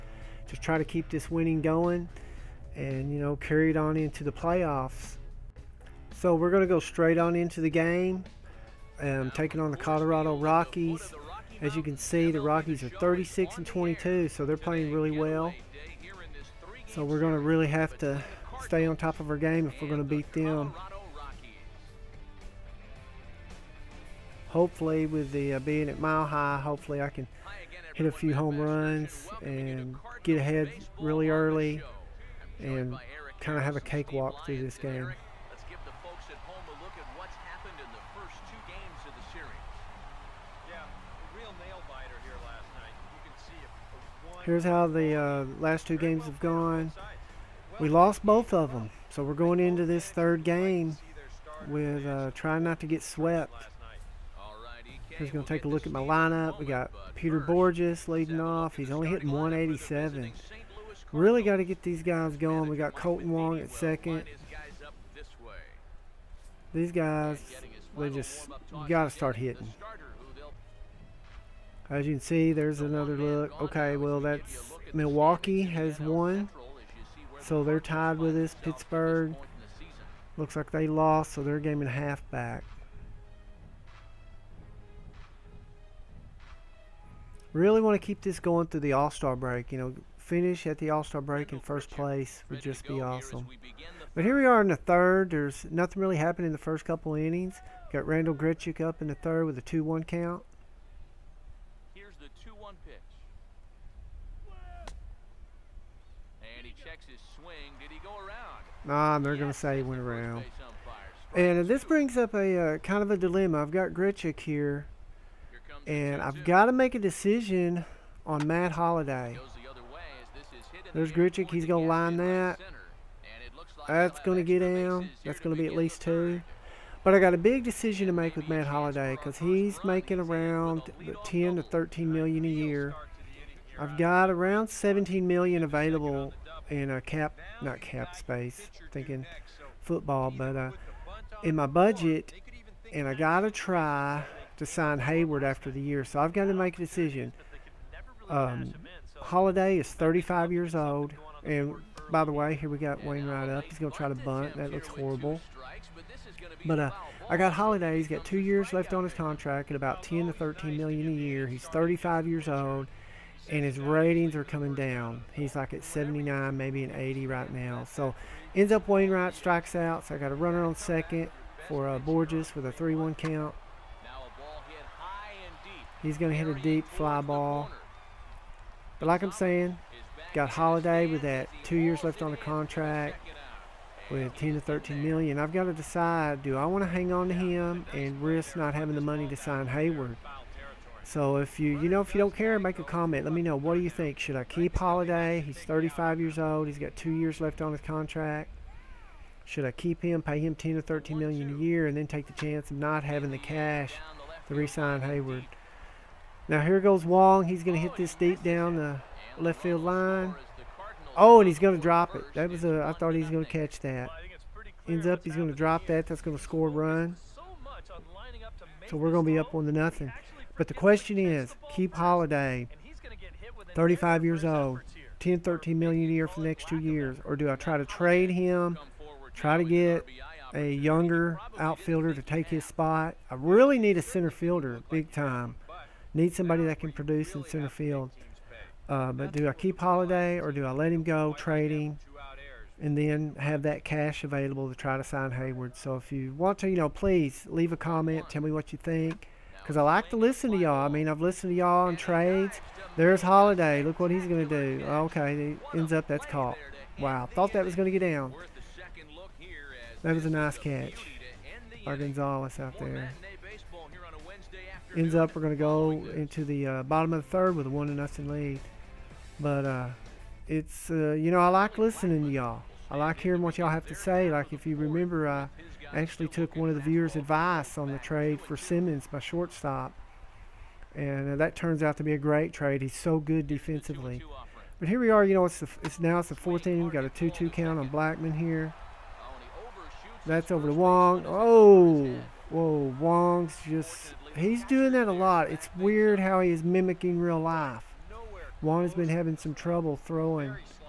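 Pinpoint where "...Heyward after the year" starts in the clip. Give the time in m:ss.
2:24.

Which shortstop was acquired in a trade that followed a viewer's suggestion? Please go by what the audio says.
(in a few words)
Simmons.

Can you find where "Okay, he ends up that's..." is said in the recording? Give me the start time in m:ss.
4:14.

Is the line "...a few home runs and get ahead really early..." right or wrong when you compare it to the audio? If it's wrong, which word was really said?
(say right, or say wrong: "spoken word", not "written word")
right.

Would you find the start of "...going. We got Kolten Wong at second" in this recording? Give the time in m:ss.
1:02.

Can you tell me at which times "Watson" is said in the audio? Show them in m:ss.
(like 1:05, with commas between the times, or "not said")
not said.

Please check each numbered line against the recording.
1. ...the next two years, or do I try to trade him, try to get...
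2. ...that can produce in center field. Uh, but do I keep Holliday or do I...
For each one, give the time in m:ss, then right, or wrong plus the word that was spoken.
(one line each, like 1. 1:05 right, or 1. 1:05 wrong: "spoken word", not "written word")
1. 3:46 right
2. 3:56 right.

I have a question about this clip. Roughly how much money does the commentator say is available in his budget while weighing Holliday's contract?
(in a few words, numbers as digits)
17 million.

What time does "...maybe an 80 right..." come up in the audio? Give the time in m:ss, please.
2:46.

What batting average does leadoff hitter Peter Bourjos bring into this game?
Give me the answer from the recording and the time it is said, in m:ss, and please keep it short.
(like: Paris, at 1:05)
187, at 0:59.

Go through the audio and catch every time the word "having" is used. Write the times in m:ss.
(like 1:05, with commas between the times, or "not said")
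3:08, 3:23, 4:59.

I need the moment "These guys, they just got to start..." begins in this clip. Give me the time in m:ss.
1:06.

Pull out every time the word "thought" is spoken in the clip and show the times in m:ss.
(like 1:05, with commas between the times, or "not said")
3:32, 4:17.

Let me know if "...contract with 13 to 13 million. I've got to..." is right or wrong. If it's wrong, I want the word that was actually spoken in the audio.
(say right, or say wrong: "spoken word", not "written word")
wrong: "10", not "13".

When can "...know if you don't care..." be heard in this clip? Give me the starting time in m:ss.
3:11.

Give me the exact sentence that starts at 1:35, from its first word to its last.
There's nothing really happened in the first couple innings.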